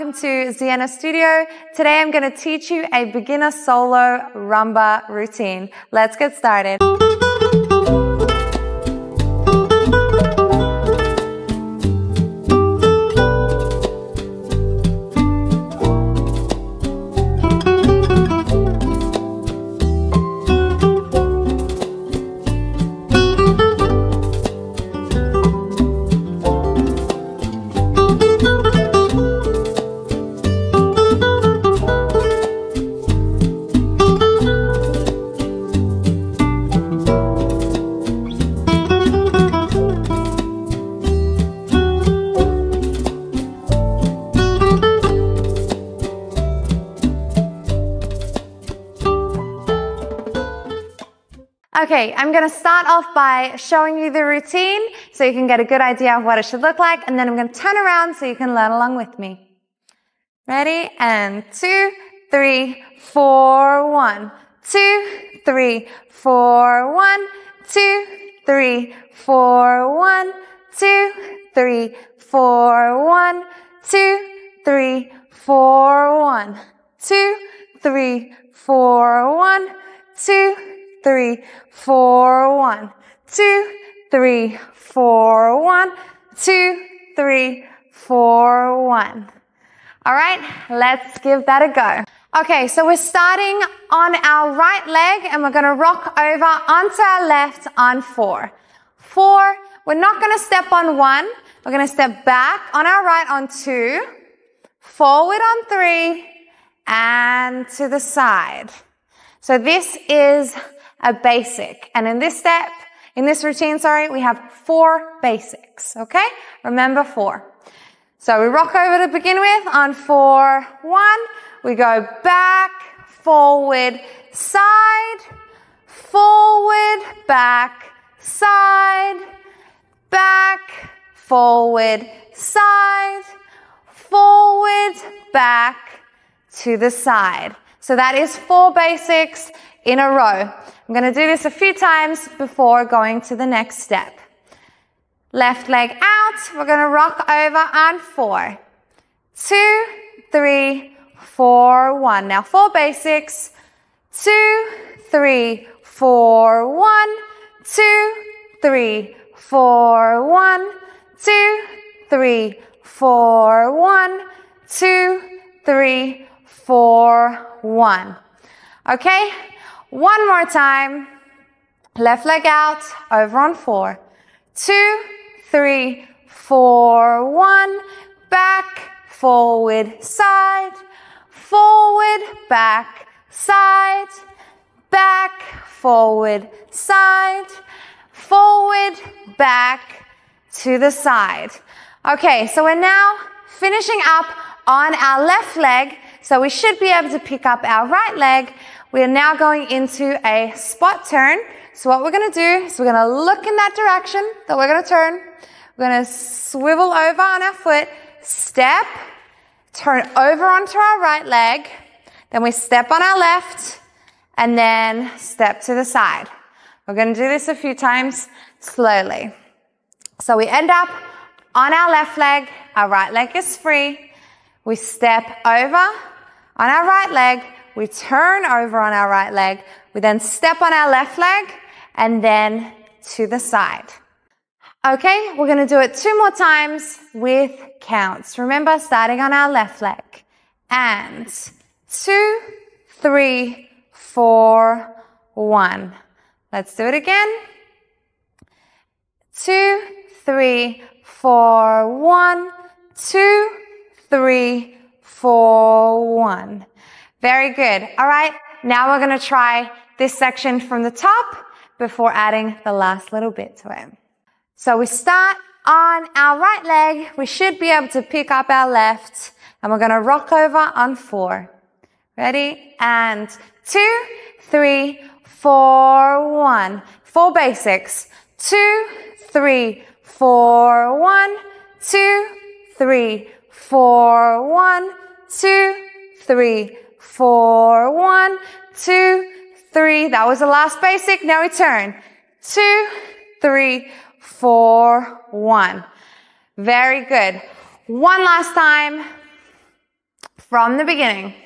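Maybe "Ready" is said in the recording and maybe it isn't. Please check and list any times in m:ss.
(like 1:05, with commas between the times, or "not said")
1:00, 4:32.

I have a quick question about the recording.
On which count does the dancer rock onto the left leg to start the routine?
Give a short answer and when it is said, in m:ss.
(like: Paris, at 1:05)
4, at 1:35.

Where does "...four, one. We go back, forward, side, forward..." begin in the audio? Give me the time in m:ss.
1:59.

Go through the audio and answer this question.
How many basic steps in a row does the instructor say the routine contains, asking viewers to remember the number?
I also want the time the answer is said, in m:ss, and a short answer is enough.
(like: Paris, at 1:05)
4, at 1:54.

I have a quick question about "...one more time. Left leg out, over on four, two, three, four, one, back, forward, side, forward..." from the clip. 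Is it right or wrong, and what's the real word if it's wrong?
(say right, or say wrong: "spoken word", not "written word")
right.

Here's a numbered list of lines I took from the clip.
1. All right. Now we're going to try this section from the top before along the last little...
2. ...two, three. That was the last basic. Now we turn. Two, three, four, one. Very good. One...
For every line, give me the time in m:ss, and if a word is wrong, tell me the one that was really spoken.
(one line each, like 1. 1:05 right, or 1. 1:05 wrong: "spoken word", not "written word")
1. 4:17 wrong: "adding", not "along"
2. 4:48 right.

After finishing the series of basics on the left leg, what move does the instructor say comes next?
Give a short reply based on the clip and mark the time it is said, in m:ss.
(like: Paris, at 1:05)
spot turn, at 3:20.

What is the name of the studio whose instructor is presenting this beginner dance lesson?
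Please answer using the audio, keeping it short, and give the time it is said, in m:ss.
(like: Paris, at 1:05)
Zienna Studio, at 0:00.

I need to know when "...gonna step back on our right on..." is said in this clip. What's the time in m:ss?
1:41.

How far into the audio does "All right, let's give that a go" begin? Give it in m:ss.
1:30.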